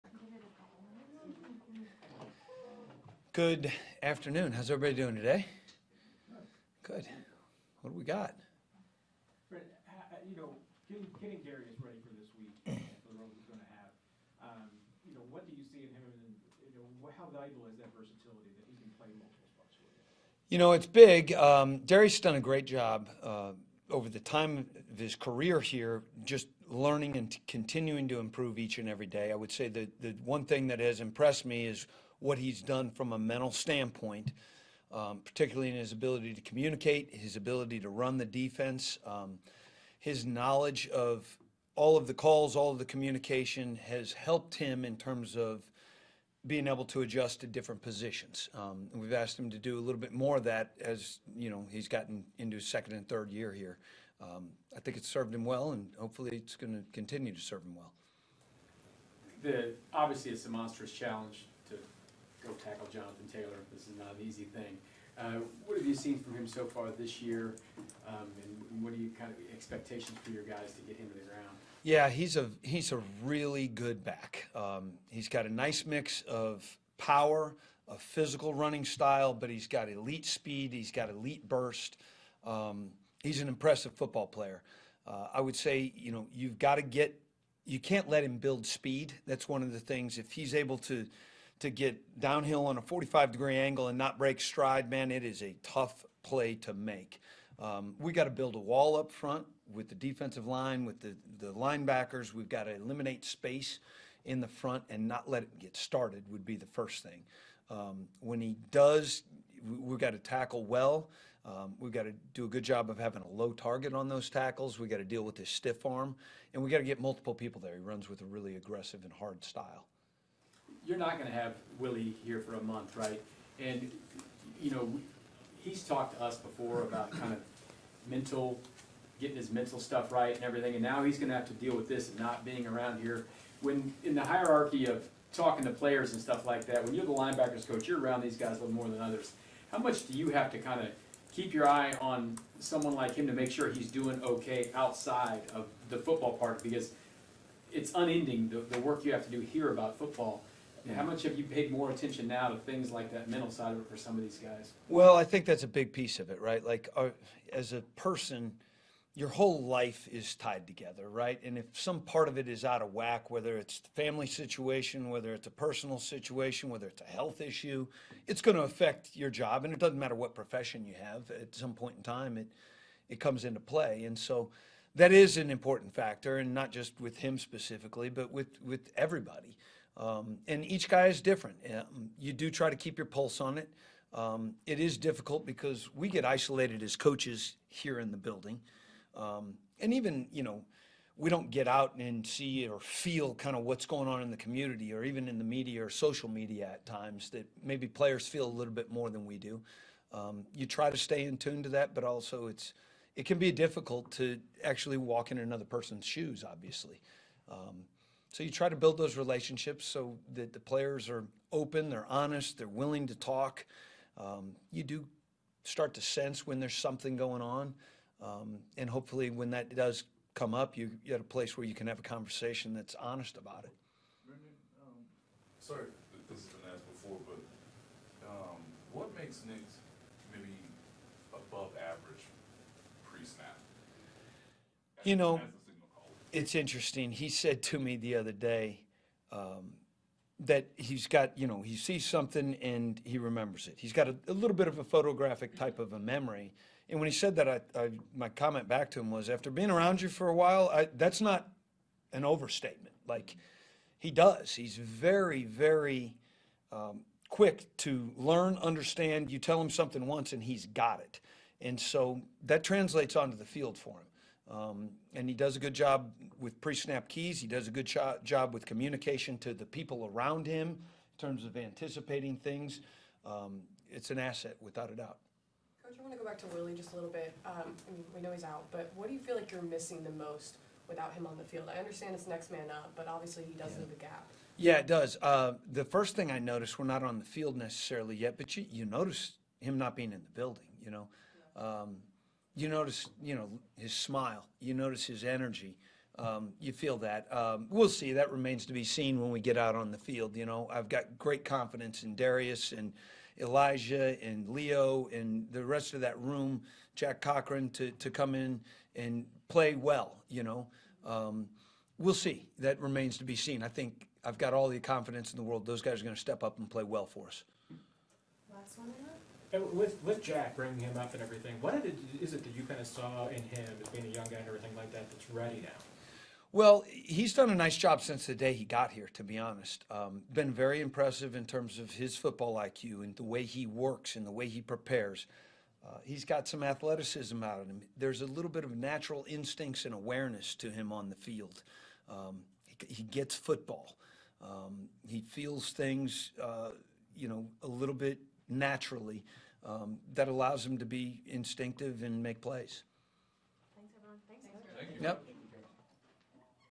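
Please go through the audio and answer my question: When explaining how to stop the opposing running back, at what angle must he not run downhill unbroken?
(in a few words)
45 degree.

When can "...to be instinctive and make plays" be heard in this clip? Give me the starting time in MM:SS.
05:50.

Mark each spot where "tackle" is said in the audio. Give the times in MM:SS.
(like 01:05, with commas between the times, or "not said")
01:02, 01:50, 01:54.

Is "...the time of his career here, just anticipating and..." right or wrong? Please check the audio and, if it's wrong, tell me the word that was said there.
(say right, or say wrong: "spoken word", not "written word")
wrong: "learning", not "anticipating".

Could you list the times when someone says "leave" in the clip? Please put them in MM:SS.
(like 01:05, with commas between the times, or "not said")
04:43.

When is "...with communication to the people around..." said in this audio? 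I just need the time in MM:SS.
04:28.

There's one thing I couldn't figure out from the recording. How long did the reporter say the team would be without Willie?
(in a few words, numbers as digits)
a month.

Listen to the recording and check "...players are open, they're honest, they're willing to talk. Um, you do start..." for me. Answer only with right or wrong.
right.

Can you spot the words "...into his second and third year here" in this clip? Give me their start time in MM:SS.
00:52.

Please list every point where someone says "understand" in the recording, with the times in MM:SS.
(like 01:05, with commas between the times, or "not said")
04:18, 04:41.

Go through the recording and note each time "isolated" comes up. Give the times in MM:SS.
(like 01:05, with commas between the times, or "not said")
03:06.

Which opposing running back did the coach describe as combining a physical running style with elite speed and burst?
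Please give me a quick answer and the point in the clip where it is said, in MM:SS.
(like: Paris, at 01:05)
Jonathan Taylor, at 01:02.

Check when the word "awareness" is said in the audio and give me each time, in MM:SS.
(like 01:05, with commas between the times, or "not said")
05:39.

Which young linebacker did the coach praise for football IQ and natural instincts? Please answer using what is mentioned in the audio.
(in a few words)
Jack Cochrane.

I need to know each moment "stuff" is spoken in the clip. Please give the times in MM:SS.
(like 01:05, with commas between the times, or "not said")
02:09, 02:16.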